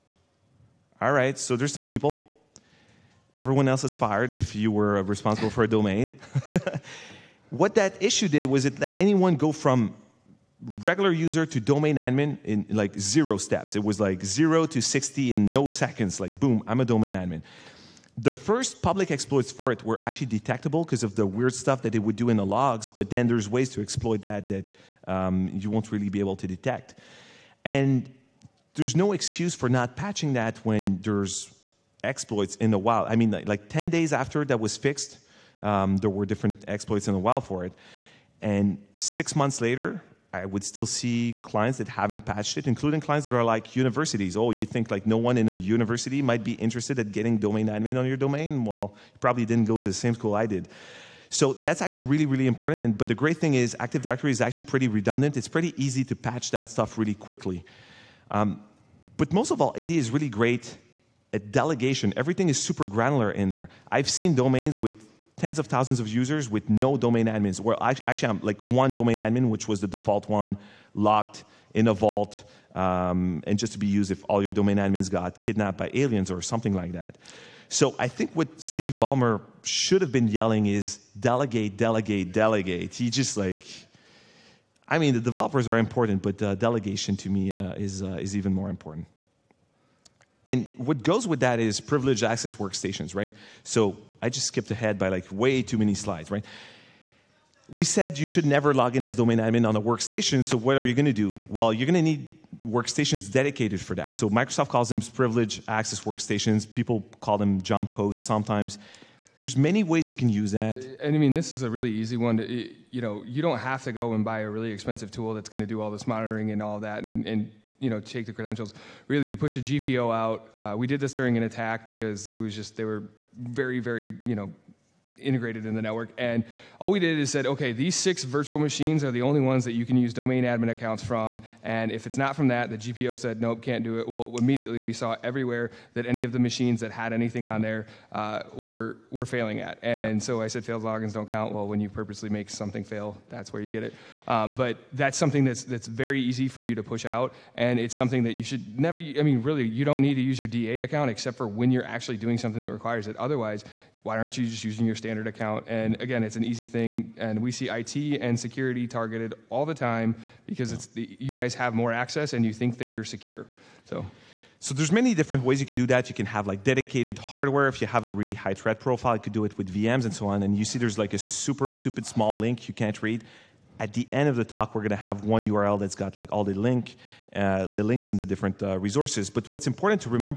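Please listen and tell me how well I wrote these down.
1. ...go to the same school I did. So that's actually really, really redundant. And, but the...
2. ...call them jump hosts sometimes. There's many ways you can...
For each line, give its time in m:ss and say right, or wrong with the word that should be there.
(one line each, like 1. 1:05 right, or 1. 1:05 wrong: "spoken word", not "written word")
1. 0:49 wrong: "important", not "redundant"
2. 1:47 right.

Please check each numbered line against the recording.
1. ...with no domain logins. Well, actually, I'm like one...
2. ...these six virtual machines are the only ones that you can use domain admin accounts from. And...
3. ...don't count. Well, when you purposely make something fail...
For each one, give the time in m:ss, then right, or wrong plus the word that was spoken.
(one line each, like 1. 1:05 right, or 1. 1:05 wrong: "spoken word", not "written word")
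1. 1:06 wrong: "admins", not "logins"
2. 2:07 right
3. 2:21 right.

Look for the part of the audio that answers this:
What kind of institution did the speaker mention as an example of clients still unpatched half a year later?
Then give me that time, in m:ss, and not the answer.
0:43.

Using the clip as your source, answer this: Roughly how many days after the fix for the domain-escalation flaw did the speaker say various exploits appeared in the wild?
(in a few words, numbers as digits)
10.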